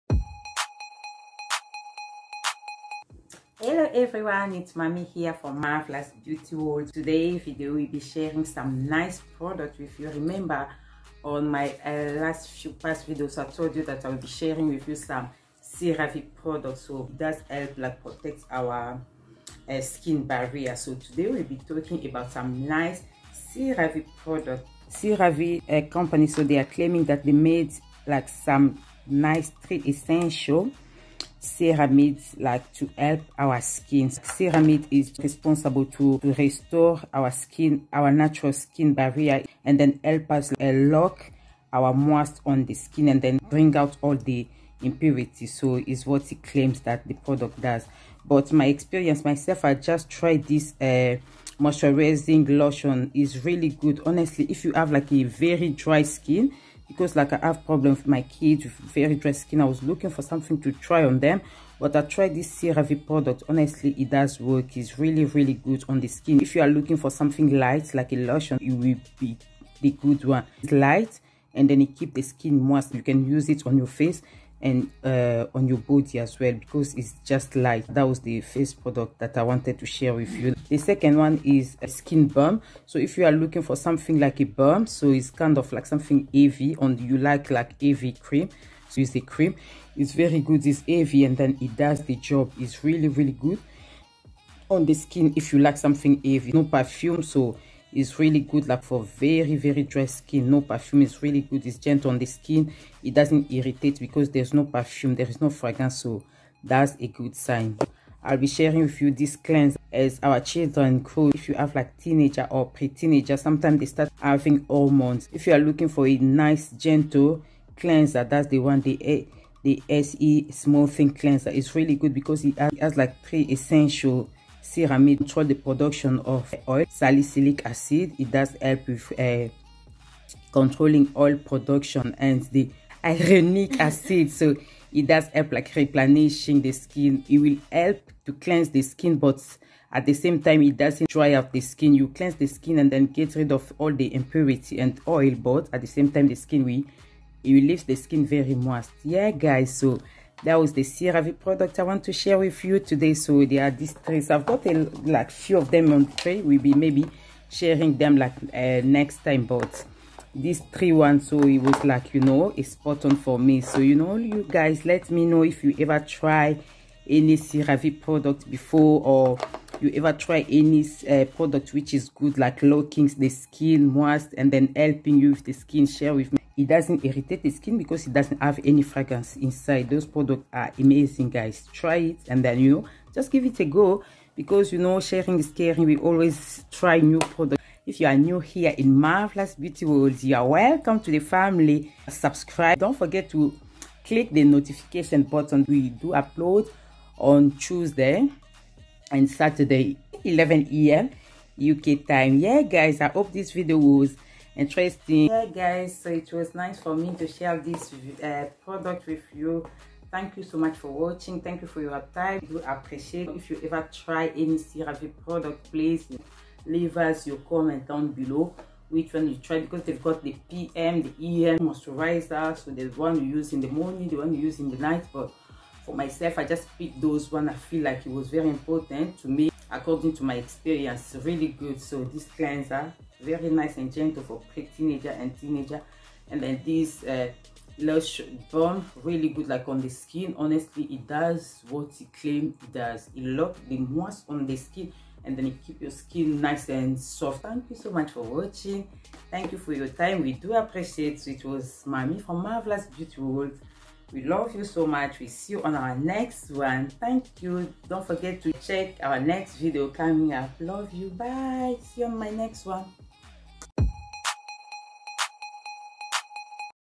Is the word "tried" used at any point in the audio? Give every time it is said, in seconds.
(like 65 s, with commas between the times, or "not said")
50 s, 62 s.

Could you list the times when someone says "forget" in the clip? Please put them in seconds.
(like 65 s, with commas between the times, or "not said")
192 s, 258 s.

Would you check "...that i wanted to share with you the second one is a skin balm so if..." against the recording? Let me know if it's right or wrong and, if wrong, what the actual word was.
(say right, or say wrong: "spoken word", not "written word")
right.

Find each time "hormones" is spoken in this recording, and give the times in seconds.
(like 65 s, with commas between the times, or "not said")
114 s.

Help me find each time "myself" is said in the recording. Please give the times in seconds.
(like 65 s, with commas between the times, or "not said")
49 s, 225 s.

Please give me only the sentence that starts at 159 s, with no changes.
But these three ones, so it was like, you know, a spot on for me.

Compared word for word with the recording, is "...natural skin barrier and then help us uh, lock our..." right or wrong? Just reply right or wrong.
right.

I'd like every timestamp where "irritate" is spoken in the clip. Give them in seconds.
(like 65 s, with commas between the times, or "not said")
103 s, 177 s.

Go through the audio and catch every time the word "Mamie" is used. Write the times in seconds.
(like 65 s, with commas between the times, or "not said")
4 s, 251 s.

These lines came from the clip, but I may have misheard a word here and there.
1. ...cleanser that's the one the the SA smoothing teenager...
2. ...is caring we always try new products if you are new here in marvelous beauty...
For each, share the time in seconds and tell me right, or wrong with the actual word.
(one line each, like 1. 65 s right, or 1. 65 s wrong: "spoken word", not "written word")
1. 117 s wrong: "cleanser", not "teenager"
2. 185 s right.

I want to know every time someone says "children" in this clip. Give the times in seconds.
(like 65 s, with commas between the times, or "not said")
110 s.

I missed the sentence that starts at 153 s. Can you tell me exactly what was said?
So there are these 3 I've got a like few of them on tray.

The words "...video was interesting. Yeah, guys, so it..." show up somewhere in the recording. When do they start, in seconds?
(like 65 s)
203 s.